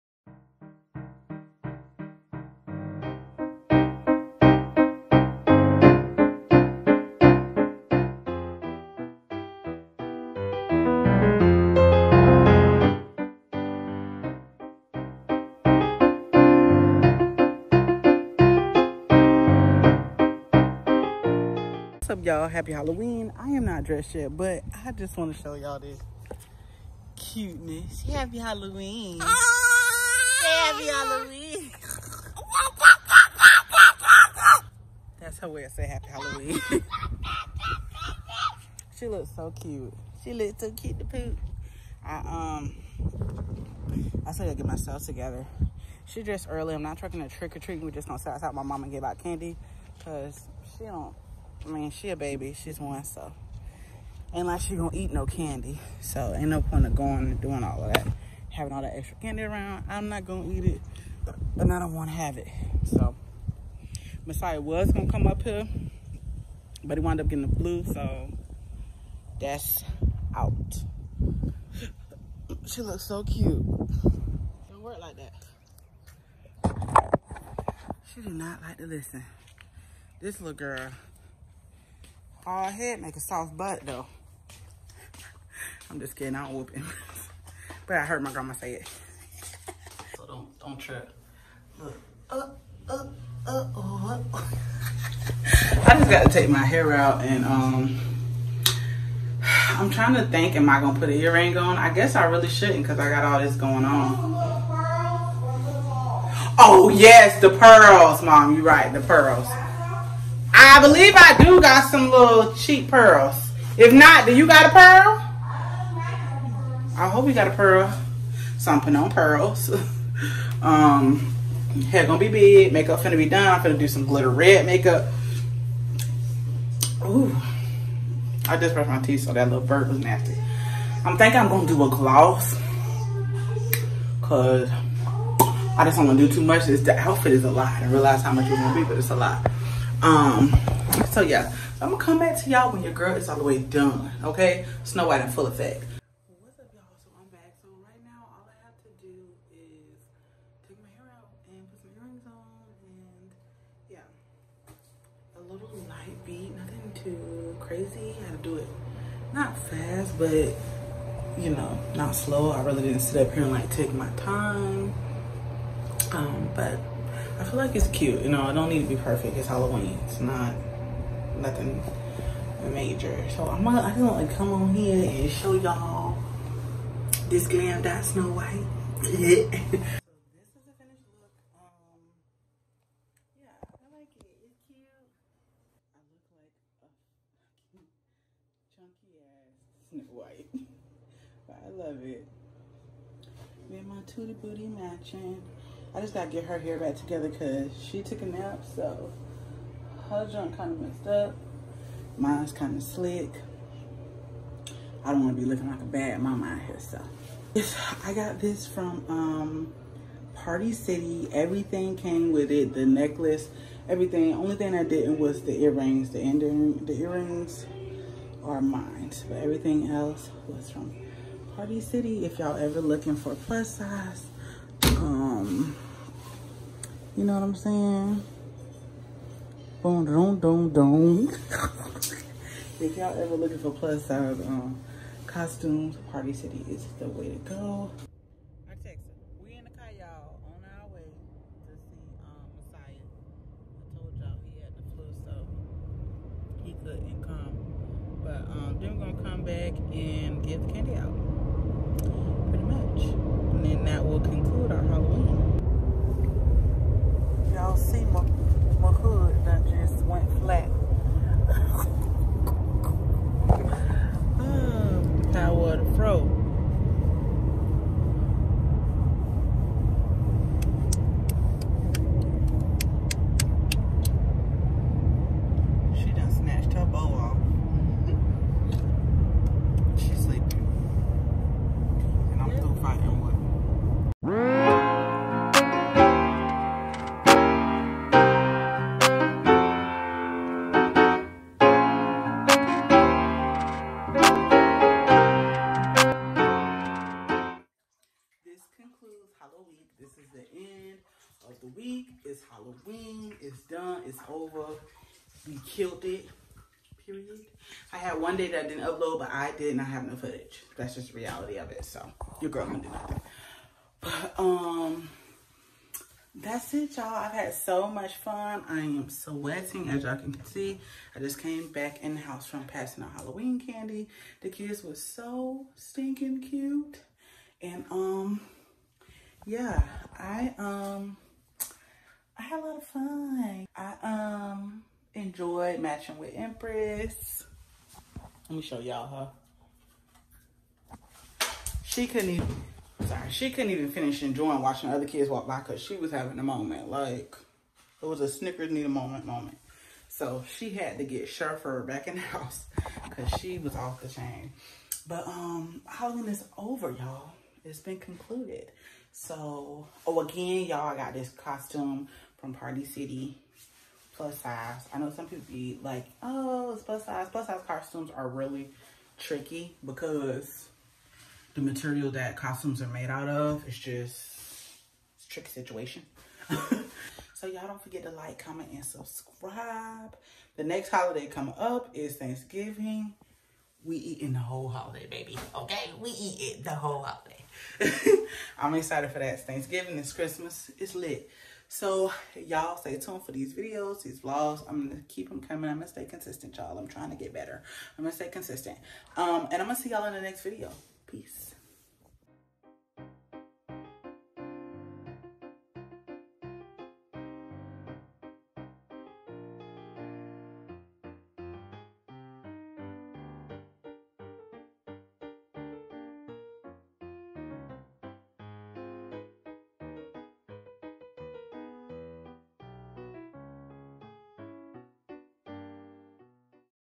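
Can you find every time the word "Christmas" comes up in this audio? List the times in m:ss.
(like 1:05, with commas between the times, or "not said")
6:30.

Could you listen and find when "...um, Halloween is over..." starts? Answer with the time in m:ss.
5:55.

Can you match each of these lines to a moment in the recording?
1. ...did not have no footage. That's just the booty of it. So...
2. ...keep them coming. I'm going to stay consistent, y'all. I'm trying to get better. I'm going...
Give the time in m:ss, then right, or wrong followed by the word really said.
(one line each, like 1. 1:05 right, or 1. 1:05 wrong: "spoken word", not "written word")
1. 5:09 wrong: "reality", not "booty"
2. 6:35 right.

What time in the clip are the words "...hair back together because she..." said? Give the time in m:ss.
3:16.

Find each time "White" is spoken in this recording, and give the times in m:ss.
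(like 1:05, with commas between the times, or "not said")
2:25, 2:58, 3:10.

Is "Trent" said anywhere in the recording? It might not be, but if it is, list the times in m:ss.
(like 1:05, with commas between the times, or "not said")
not said.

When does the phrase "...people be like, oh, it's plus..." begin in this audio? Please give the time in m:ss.
6:05.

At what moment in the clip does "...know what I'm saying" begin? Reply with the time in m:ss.
3:47.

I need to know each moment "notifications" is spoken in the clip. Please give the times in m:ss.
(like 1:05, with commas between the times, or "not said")
not said.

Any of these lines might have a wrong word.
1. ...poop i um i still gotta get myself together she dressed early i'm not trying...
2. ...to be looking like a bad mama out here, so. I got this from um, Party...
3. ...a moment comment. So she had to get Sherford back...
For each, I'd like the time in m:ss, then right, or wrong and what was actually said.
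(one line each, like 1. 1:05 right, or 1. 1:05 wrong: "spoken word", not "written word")
1. 0:41 right
2. 3:25 right
3. 5:48 wrong: "moment", not "comment".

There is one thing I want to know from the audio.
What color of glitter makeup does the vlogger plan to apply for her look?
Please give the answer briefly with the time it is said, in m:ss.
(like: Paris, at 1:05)
red, at 2:04.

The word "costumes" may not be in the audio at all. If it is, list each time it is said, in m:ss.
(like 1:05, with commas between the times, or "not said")
3:55, 6:01, 6:07, 6:12.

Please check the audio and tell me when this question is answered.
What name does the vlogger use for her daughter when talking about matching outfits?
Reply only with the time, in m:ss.
5:35.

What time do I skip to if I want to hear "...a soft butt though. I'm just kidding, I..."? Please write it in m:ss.
1:23.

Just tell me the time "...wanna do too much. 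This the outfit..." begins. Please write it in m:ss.
2:16.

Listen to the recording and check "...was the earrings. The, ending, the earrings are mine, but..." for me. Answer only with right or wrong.
right.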